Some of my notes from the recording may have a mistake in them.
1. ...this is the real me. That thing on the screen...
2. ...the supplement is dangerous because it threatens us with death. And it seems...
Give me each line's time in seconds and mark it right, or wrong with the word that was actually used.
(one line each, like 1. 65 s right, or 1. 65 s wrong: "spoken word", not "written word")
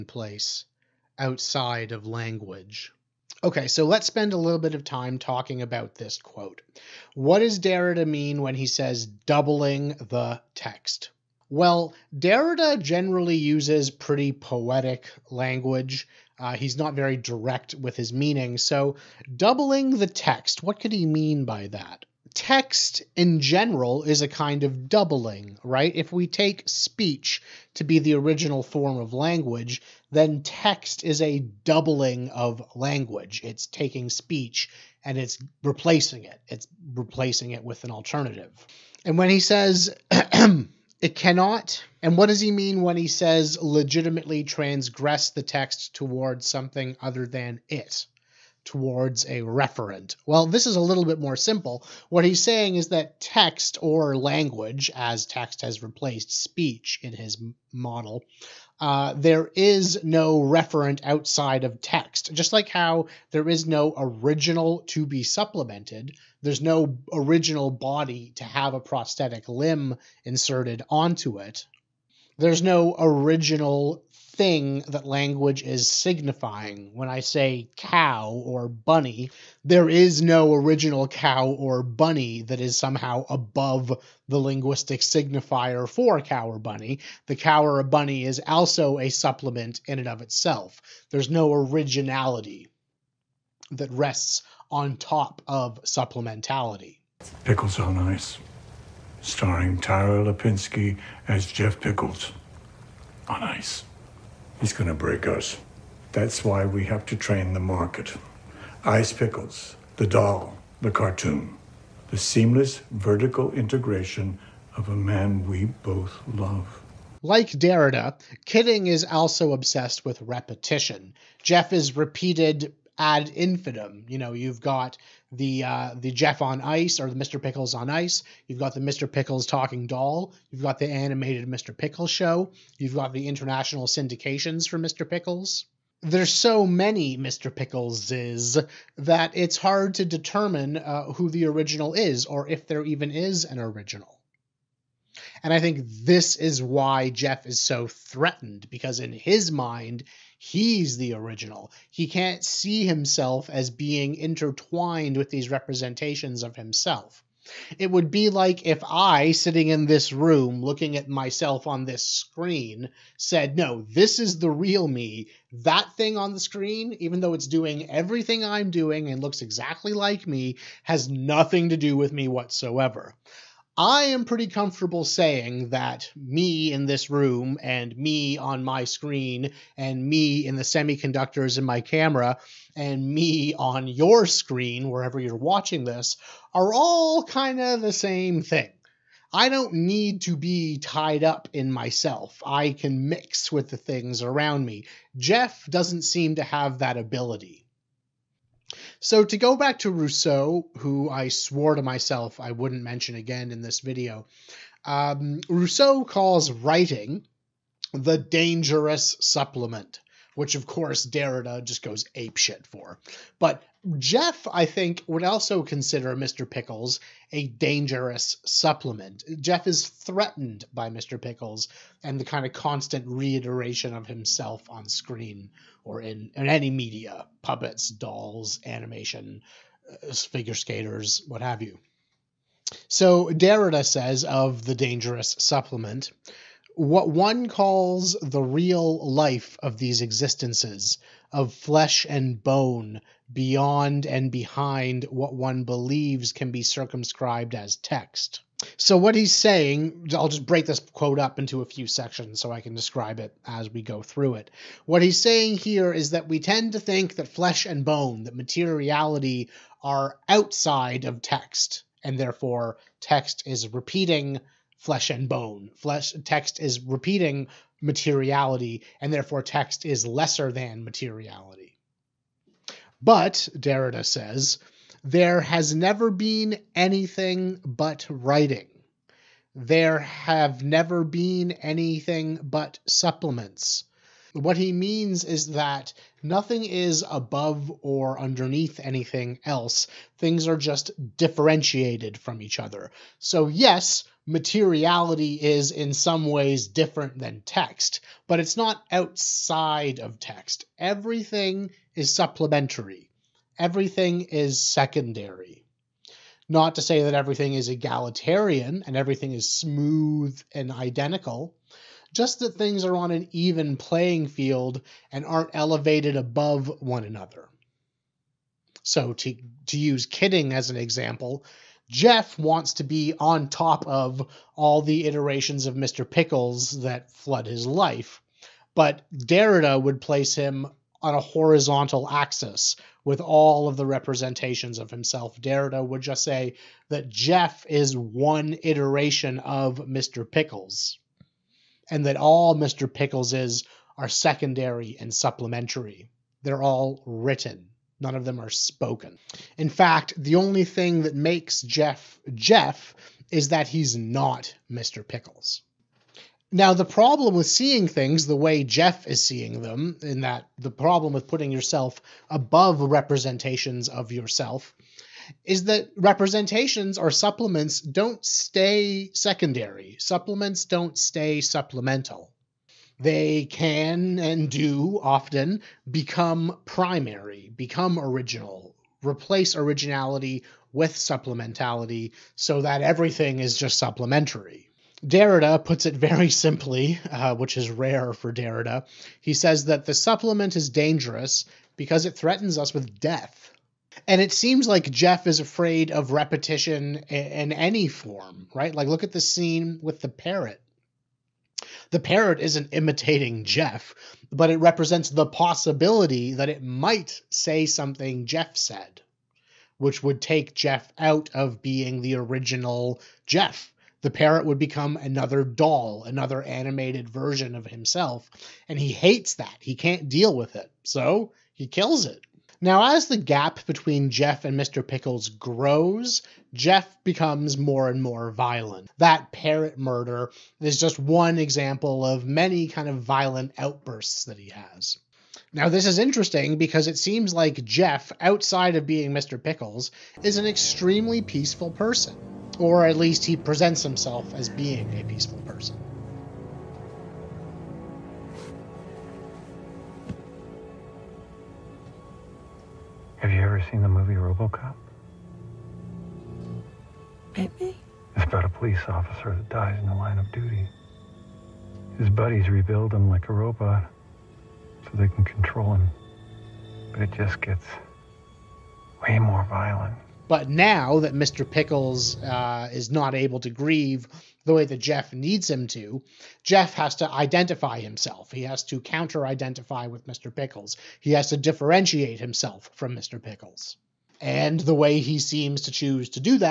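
1. 163 s right
2. 389 s right.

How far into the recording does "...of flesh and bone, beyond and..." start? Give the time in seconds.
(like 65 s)
241 s.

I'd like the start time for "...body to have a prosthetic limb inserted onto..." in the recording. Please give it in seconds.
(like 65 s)
67 s.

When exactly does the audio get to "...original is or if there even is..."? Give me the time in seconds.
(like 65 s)
141 s.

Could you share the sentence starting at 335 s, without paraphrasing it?
Derrida would just say that Jeff is one iteration of Mr.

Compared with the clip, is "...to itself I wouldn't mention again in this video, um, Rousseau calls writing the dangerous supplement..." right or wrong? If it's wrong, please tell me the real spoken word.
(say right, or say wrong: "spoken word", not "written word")
wrong: "myself", not "itself".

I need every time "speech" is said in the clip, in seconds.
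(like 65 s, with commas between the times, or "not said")
26 s, 34 s, 56 s.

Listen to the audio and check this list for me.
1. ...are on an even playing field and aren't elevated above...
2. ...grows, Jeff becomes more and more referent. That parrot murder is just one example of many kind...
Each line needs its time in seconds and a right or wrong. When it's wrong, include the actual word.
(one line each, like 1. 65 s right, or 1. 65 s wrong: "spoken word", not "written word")
1. 312 s right
2. 425 s wrong: "violent", not "referent".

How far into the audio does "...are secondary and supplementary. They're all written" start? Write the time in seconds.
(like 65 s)
343 s.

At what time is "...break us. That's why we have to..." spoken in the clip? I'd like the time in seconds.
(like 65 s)
104 s.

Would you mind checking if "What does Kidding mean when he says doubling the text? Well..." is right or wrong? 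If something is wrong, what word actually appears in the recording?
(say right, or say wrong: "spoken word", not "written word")
wrong: "Derrida", not "Kidding".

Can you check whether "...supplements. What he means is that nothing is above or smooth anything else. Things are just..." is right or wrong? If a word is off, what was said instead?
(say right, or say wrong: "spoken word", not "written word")
wrong: "underneath", not "smooth".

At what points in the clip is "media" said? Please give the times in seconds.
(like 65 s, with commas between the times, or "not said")
226 s.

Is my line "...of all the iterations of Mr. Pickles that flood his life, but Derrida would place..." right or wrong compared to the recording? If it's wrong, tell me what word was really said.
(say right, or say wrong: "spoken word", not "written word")
right.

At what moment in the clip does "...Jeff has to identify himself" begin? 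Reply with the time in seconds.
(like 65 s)
476 s.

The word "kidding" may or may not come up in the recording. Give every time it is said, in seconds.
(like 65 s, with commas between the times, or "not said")
118 s, 320 s.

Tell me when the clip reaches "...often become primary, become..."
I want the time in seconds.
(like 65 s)
375 s.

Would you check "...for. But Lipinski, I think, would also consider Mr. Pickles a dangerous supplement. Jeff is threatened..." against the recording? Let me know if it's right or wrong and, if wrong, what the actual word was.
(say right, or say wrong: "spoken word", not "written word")
wrong: "Jeff", not "Lipinski".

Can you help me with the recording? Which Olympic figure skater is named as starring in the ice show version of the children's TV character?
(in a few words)
Tara Lipinski.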